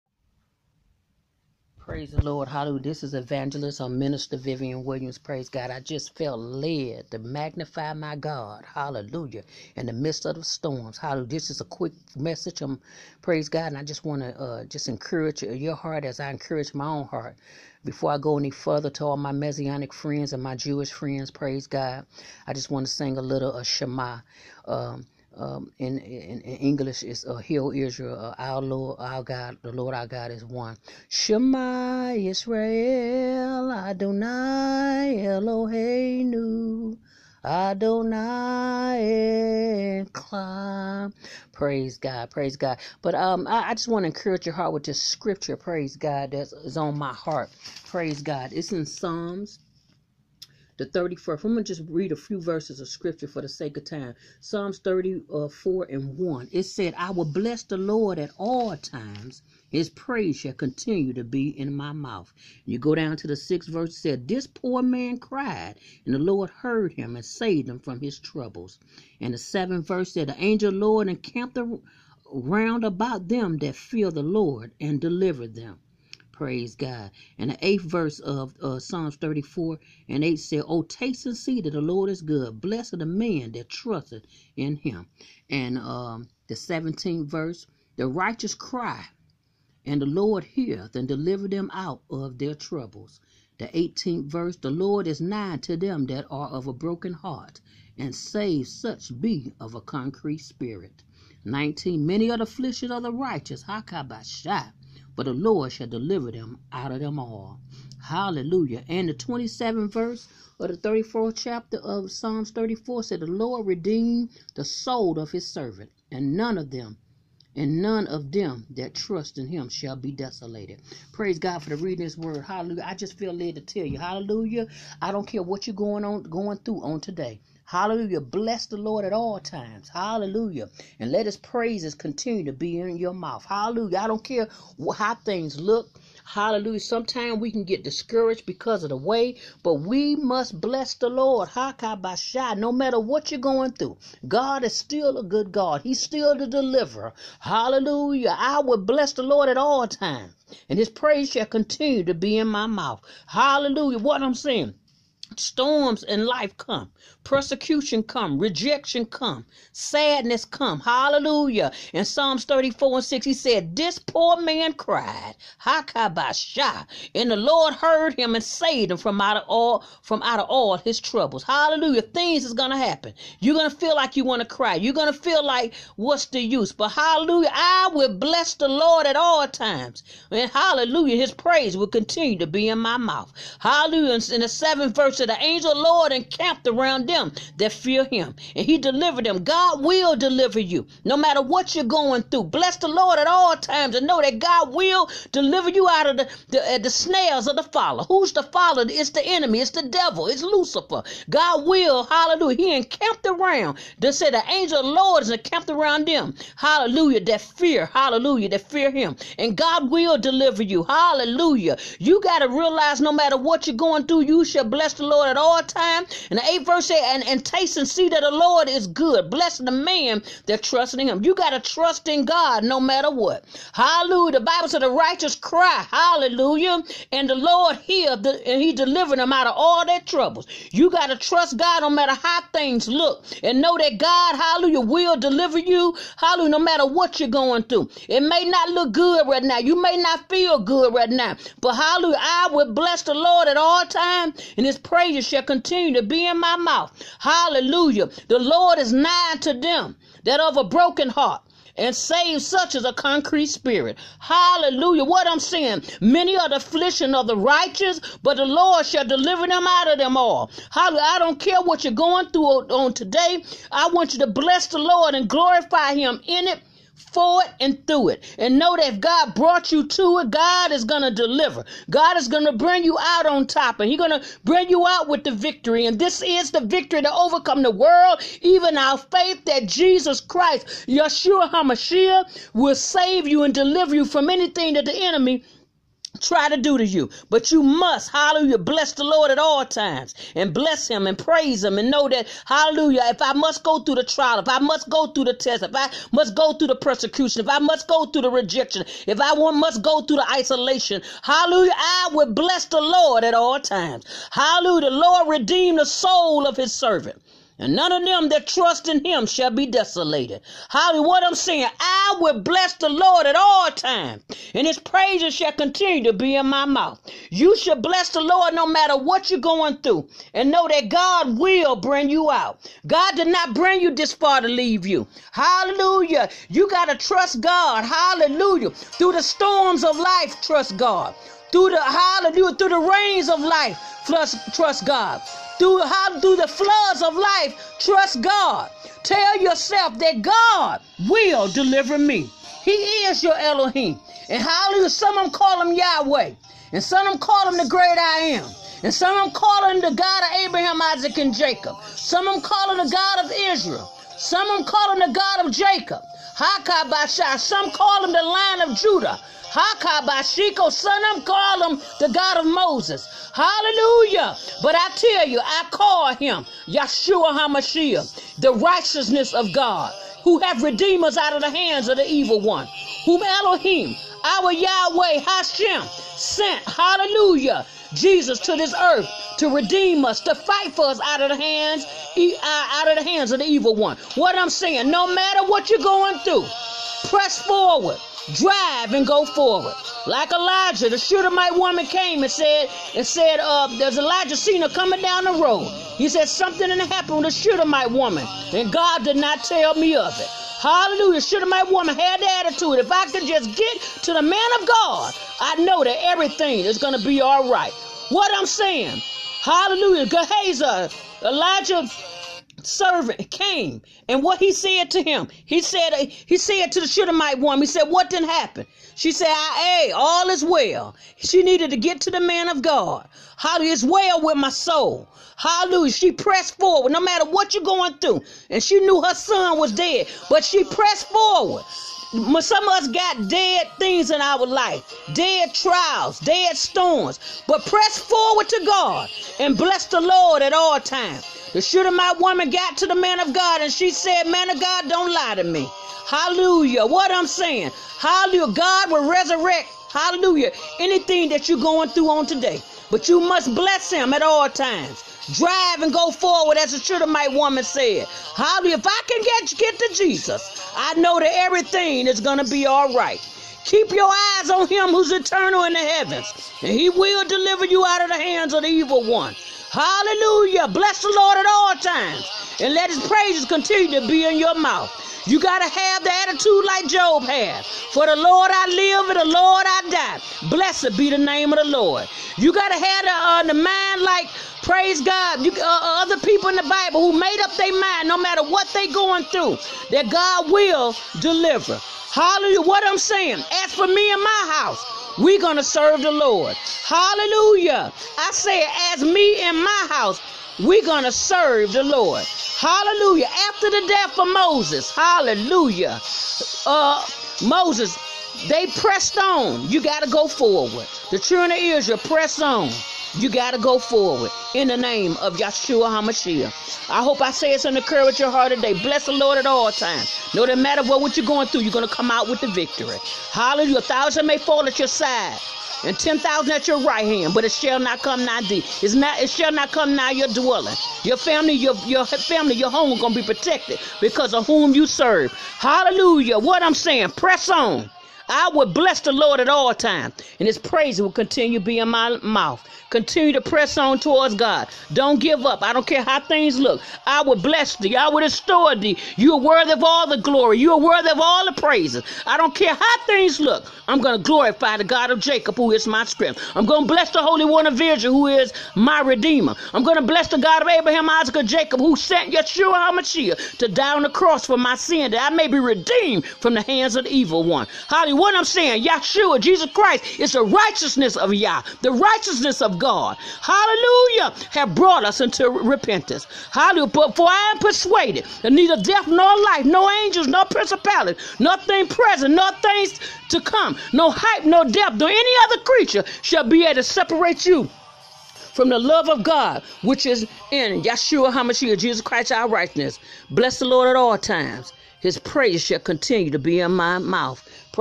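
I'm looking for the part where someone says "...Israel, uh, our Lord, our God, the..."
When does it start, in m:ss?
0:27.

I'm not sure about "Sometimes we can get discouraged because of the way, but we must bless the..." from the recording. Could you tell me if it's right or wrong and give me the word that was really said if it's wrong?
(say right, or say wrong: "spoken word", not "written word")
right.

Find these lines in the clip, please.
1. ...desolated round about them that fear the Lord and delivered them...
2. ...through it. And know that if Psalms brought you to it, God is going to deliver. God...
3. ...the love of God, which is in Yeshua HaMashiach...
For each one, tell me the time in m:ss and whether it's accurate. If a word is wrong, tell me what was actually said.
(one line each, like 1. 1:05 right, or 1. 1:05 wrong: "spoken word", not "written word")
1. 1:11 wrong: "encamped", not "desolated"
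2. 4:27 wrong: "God", not "Psalms"
3. 9:48 right.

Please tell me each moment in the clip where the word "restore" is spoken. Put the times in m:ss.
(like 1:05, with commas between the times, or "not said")
9:08.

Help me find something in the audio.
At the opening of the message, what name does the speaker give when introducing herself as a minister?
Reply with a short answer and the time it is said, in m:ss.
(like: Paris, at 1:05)
Vivian Williams, at 0:04.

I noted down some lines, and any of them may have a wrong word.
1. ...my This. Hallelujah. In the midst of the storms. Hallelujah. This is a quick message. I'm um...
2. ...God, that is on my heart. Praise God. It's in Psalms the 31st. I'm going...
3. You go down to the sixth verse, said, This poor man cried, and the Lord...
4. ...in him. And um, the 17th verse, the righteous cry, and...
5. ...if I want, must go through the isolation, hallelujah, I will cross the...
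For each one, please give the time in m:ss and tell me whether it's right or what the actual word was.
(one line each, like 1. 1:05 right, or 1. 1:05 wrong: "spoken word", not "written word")
1. 0:07 wrong: "God", not "This"
2. 0:45 right
3. 1:02 right
4. 1:24 right
5. 4:59 wrong: "bless", not "cross".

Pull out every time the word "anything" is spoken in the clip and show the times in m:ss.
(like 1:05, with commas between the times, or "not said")
4:44, 7:30.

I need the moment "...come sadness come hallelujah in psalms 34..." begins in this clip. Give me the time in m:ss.
2:39.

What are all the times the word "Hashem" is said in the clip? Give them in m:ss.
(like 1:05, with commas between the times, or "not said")
6:15.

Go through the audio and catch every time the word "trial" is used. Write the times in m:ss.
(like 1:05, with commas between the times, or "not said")
4:54, 7:15.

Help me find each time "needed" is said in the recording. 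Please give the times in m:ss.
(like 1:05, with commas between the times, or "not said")
7:01.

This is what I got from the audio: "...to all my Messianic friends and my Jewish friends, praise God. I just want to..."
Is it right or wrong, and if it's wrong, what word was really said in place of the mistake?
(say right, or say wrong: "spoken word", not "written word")
right.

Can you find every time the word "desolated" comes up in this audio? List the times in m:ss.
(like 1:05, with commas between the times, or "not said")
2:00, 5:09.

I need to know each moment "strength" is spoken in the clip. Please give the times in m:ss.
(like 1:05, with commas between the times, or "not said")
9:16.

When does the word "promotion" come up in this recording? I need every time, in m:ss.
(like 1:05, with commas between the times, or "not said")
not said.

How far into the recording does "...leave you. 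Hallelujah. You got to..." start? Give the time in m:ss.
5:24.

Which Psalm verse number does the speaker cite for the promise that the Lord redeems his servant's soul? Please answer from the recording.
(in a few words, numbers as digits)
27th.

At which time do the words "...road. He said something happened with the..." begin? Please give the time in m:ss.
6:35.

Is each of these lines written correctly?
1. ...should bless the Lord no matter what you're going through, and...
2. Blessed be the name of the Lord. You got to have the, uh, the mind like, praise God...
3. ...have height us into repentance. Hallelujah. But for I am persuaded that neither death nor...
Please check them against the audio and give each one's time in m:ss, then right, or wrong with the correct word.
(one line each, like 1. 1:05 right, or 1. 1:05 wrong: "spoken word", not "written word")
1. 5:17 right
2. 8:00 right
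3. 9:34 wrong: "brought", not "height".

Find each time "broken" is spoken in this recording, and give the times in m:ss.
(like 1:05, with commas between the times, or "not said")
1:36, 4:10.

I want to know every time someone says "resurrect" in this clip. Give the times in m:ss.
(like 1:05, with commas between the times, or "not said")
7:29.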